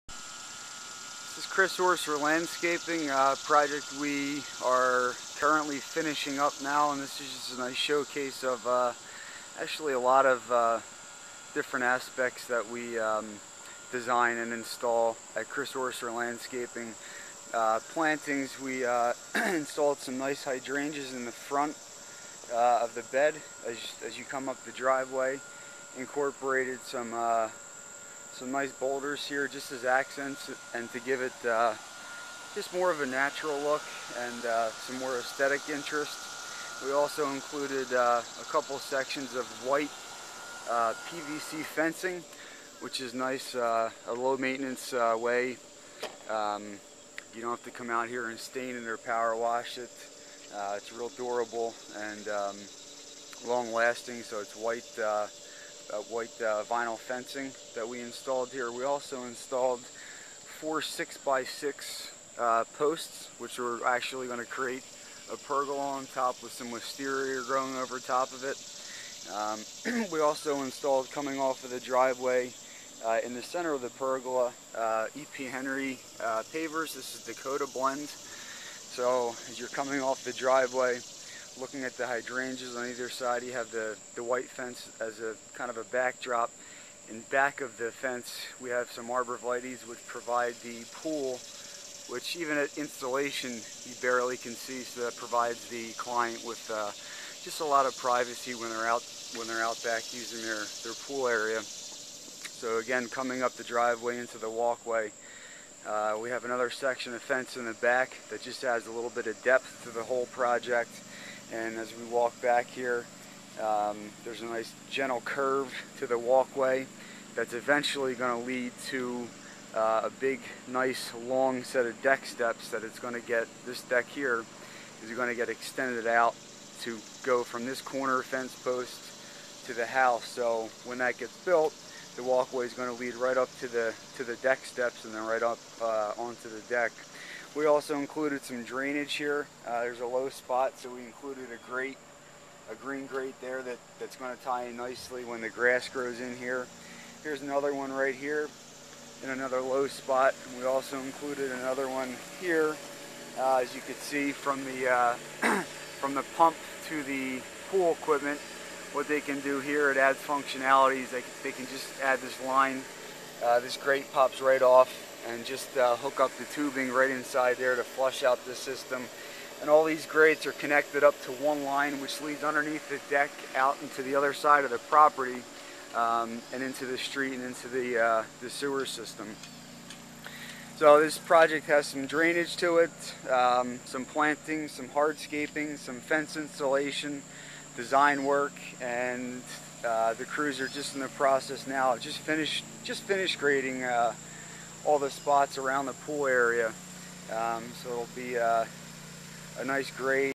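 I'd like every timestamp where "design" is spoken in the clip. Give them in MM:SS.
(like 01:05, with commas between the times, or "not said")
00:13, 03:07.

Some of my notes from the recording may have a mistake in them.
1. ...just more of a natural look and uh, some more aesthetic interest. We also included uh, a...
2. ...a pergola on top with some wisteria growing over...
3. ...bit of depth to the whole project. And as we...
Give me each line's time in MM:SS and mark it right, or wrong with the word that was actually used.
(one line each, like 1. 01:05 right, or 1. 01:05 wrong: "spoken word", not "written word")
1. 00:32 right
2. 01:05 right
3. 01:49 right.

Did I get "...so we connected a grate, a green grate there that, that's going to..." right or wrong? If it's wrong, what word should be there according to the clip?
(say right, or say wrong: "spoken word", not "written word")
wrong: "included", not "connected".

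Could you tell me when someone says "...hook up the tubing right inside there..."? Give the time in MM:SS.
02:45.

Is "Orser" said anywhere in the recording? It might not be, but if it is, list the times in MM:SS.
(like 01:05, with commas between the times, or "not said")
00:01, 00:15.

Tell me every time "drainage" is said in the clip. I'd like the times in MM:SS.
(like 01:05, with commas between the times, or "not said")
02:18, 03:02.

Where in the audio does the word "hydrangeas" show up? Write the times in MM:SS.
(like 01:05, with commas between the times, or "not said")
00:20, 01:22.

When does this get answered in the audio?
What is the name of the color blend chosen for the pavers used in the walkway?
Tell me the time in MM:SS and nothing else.
01:17.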